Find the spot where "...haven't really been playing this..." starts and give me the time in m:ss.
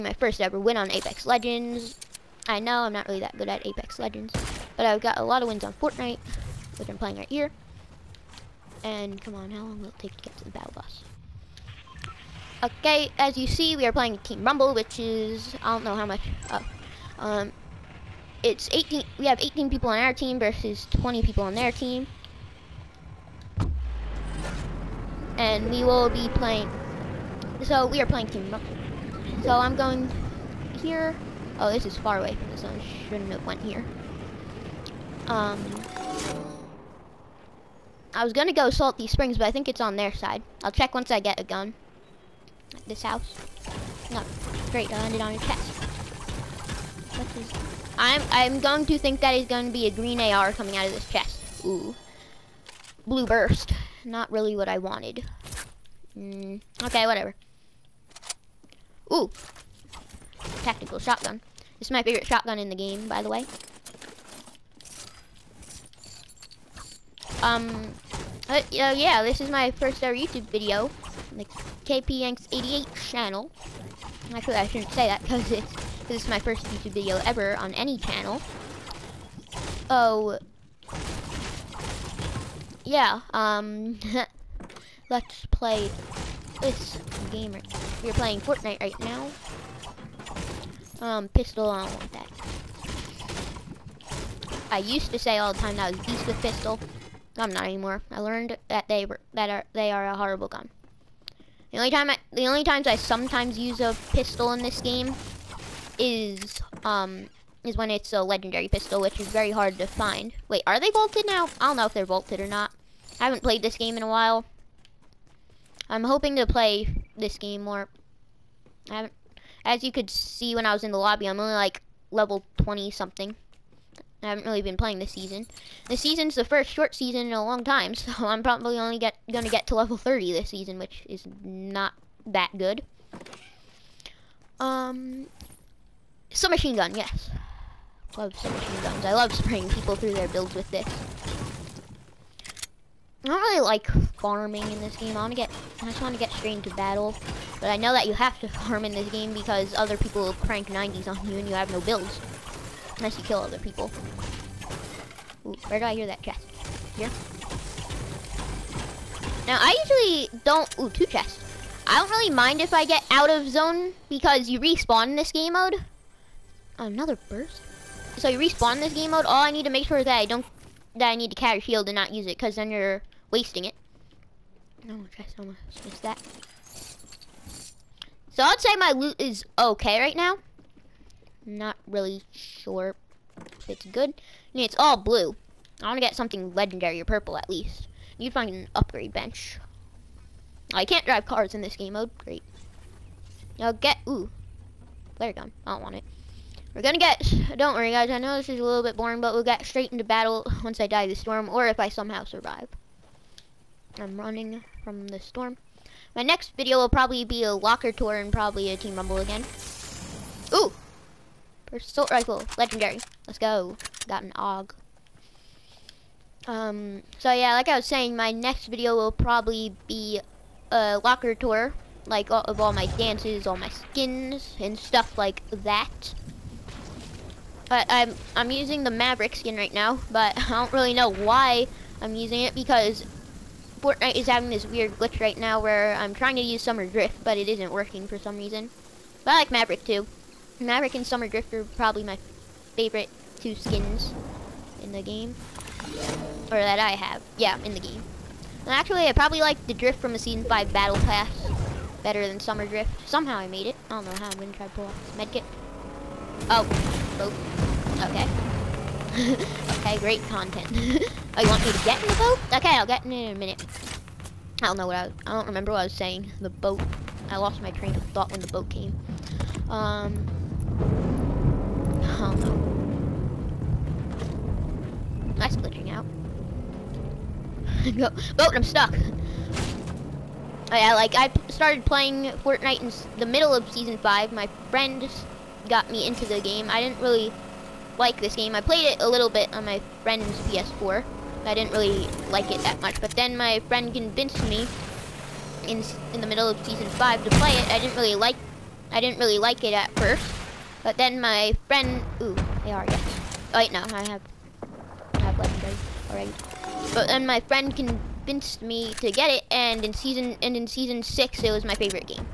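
2:04.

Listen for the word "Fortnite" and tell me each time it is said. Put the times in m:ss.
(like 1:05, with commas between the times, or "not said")
0:05, 1:28, 3:53, 4:42.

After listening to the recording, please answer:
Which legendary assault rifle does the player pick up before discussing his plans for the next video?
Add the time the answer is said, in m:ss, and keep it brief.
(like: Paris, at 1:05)
AUG, at 3:34.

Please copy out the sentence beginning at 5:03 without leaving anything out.
wait, no, I have, I have legendary already.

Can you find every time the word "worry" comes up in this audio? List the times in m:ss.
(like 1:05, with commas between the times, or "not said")
3:17.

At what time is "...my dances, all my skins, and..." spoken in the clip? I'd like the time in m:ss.
3:42.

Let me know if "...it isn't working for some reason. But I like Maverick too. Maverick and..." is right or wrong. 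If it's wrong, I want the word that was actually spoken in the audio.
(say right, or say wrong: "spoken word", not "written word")
right.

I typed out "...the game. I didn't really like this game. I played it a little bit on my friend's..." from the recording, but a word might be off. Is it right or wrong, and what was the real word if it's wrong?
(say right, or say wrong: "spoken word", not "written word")
right.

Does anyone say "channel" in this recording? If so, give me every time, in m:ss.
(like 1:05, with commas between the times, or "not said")
1:13, 1:17.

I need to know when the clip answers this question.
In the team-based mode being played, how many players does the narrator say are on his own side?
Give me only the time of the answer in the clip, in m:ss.
0:19.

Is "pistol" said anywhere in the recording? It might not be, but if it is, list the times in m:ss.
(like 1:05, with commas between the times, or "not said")
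1:31, 1:36, 1:44, 1:48.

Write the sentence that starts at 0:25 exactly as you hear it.
And we will be playing, so we are playing Team Rumble.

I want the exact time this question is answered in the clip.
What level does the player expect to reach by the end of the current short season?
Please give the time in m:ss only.
2:09.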